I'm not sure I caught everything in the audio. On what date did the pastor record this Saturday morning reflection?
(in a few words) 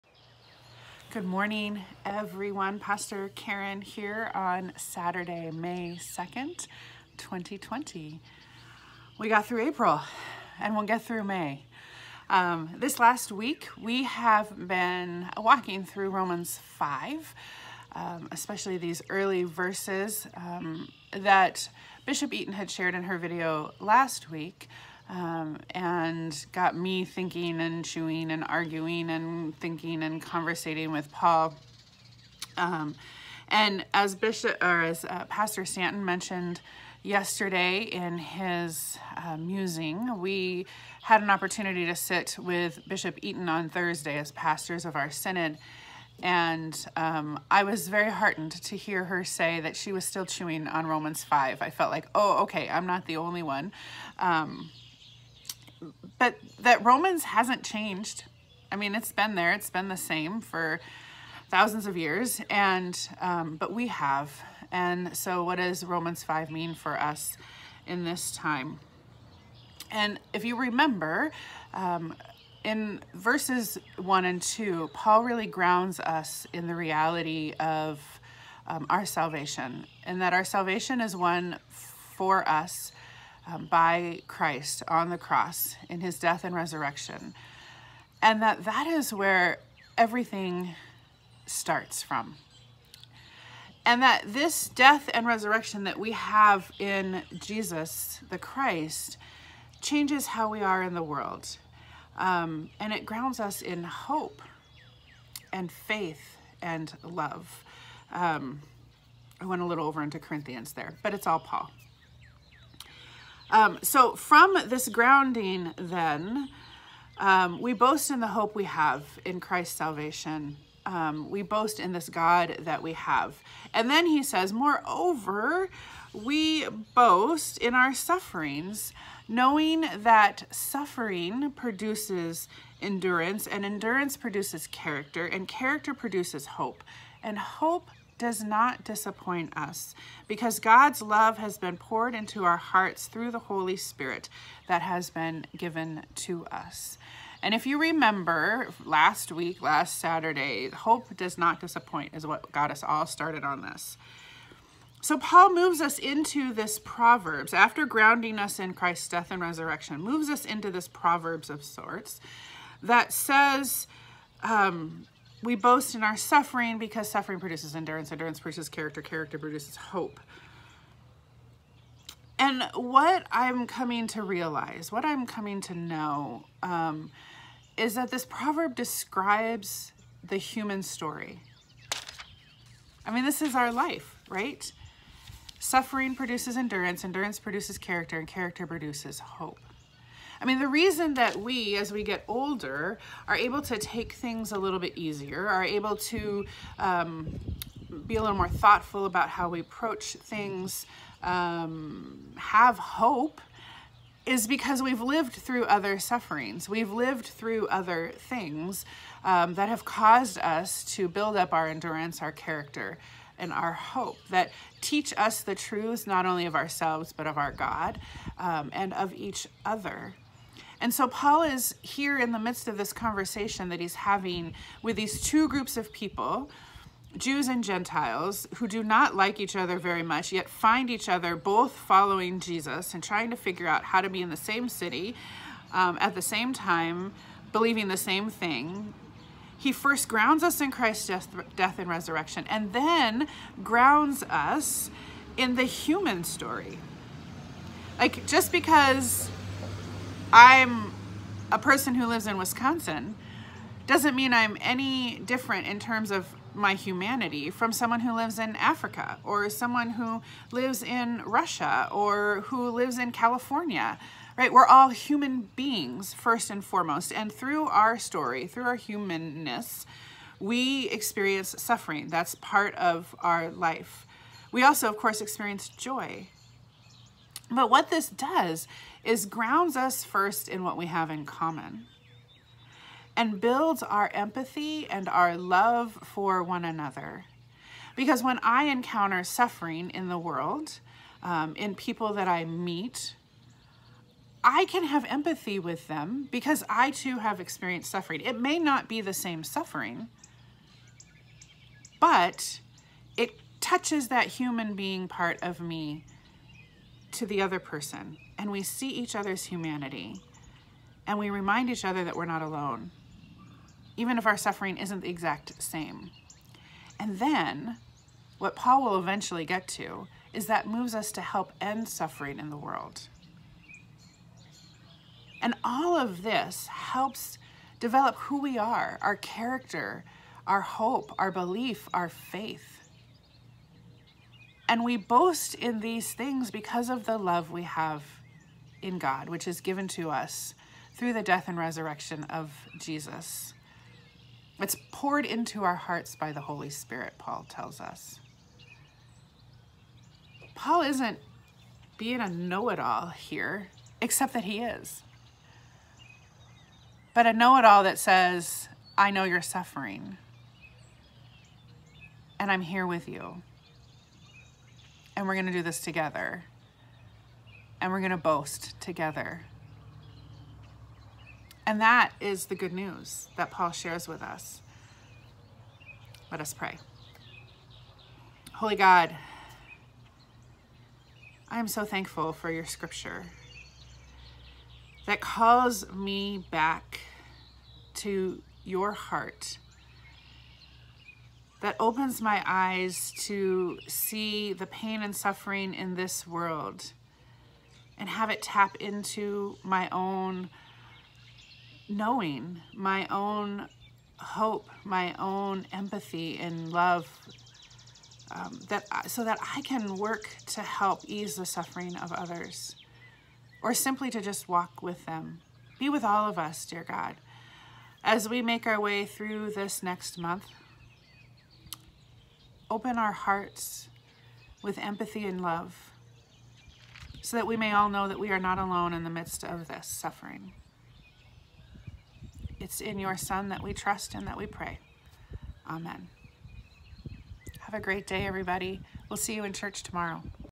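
May 2nd, 2020.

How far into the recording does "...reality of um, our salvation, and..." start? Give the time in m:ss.
1:16.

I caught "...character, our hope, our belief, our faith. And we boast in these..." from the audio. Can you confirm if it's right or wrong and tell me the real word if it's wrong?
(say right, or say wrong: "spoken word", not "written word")
right.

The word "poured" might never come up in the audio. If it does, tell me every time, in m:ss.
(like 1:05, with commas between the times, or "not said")
2:21, 5:44.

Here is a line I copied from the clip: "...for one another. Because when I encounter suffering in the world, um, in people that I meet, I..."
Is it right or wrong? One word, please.
right.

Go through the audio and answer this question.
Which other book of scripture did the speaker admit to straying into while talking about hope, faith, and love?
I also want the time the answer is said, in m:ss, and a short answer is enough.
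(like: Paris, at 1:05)
Corinthians, at 1:50.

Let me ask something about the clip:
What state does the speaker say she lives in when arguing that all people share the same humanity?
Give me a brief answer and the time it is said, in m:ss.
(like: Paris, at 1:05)
Wisconsin, at 4:12.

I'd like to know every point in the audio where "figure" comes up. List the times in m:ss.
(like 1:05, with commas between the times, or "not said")
3:53.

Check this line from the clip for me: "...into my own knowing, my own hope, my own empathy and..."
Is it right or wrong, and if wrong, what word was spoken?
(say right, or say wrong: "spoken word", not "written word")
right.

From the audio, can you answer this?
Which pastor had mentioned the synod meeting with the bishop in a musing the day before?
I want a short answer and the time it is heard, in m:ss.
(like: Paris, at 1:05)
Pastor Stanton, at 0:35.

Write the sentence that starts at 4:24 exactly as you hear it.
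We're all human beings first and foremost.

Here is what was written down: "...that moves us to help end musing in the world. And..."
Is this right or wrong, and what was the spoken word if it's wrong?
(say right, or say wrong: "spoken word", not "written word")
wrong: "suffering", not "musing".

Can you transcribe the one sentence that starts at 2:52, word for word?
And what I'm coming to realize, what I'm coming to know, um, is that this proverb describes the human story.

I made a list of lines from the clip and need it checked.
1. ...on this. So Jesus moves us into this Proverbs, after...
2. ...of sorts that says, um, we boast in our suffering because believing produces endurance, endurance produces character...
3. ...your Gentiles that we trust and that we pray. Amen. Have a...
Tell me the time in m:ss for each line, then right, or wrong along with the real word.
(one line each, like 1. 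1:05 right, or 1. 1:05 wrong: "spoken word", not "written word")
1. 2:33 wrong: "Paul", not "Jesus"
2. 2:41 wrong: "suffering", not "believing"
3. 7:12 wrong: "Son", not "Gentiles".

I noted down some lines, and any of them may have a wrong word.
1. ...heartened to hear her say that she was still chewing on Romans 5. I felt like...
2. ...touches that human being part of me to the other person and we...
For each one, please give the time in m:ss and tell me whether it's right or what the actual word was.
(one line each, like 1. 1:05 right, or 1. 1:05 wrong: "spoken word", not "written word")
1. 0:48 right
2. 5:03 right.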